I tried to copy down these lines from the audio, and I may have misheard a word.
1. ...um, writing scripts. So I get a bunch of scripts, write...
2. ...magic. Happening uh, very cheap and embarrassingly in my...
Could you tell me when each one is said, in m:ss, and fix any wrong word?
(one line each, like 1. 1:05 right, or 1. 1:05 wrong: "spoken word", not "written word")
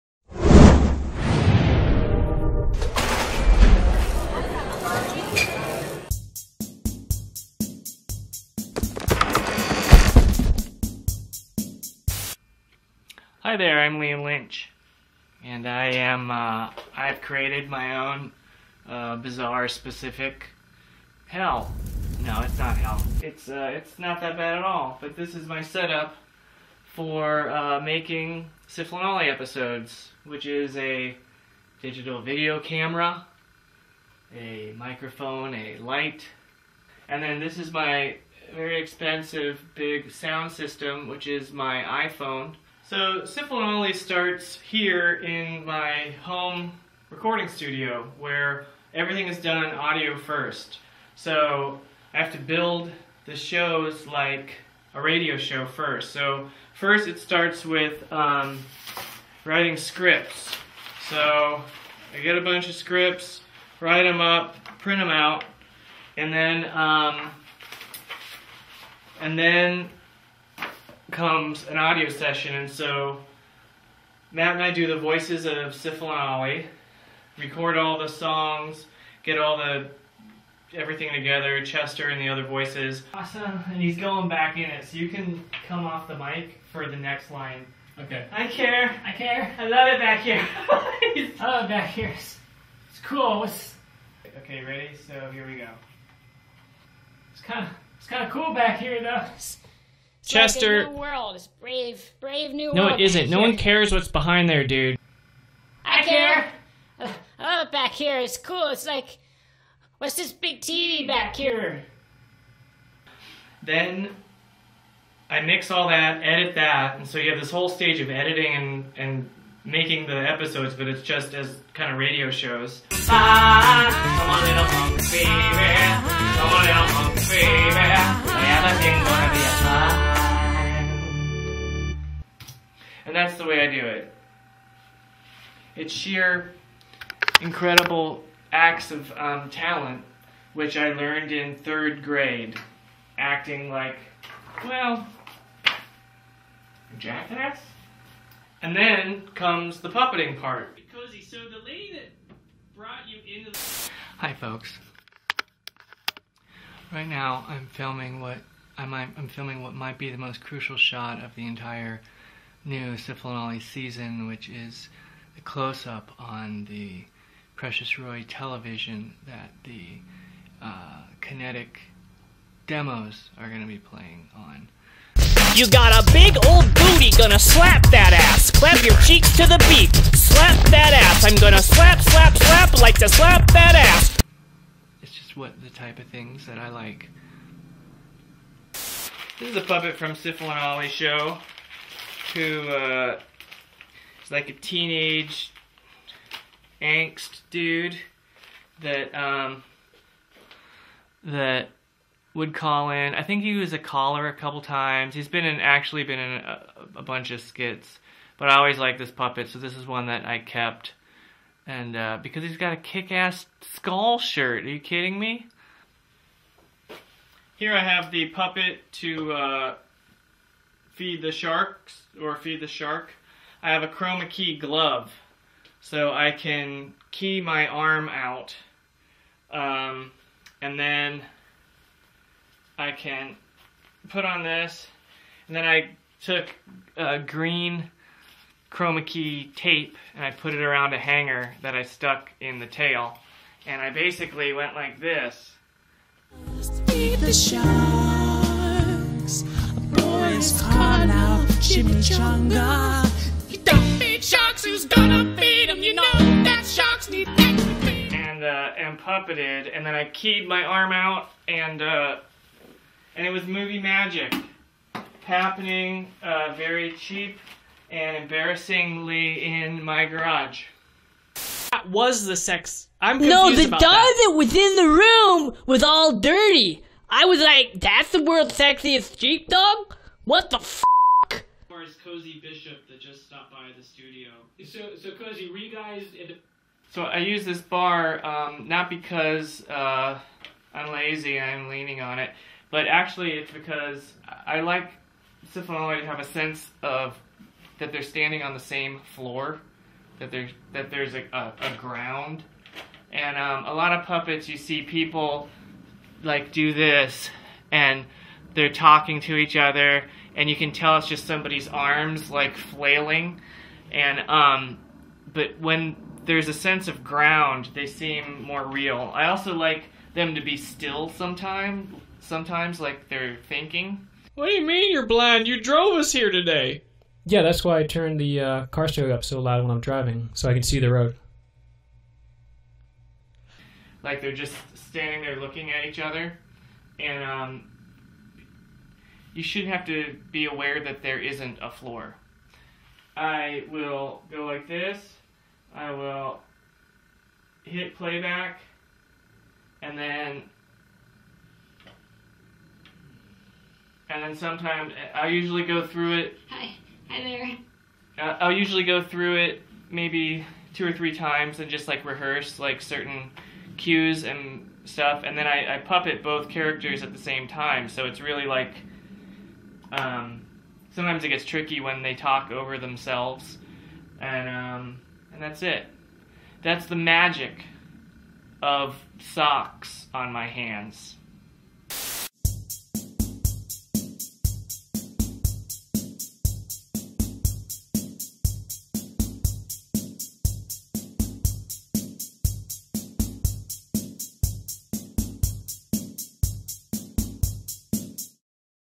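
1. 0:58 right
2. 4:23 right.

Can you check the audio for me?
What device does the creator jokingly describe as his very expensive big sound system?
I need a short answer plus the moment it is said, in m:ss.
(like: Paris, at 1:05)
iPhone, at 0:41.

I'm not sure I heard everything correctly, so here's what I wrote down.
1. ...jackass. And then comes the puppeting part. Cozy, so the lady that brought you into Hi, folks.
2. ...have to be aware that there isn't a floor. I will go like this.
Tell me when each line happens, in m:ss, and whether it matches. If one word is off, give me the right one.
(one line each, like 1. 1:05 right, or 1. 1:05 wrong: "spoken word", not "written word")
1. 2:26 right
2. 5:39 right.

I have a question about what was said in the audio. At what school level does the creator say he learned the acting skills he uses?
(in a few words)
third grade.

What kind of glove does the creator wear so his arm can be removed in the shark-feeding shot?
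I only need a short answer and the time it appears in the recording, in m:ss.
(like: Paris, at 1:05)
chroma key glove, at 3:43.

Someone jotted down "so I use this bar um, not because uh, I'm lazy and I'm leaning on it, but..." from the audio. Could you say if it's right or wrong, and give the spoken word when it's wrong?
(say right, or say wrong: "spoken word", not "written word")
right.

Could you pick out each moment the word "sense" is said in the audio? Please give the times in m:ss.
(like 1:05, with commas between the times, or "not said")
4:56, 5:16.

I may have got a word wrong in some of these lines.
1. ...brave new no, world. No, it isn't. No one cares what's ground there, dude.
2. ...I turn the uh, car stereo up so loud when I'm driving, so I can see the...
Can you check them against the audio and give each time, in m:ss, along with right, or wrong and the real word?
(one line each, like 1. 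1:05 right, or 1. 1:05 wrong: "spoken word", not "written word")
1. 1:42 wrong: "behind", not "ground"
2. 5:27 right.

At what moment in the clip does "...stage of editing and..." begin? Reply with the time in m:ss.
1:57.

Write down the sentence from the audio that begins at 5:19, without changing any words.
I also like them to be still sometimes, sometimes like they're thinking.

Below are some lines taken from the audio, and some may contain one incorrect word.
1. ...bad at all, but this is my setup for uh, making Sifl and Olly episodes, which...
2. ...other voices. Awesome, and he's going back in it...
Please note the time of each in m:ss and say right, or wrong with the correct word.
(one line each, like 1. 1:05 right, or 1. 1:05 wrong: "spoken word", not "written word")
1. 0:24 right
2. 1:22 right.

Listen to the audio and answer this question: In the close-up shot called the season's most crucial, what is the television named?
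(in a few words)
Precious Roy.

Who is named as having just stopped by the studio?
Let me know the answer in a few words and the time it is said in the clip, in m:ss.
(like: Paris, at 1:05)
Cozy Bishop, at 4:42.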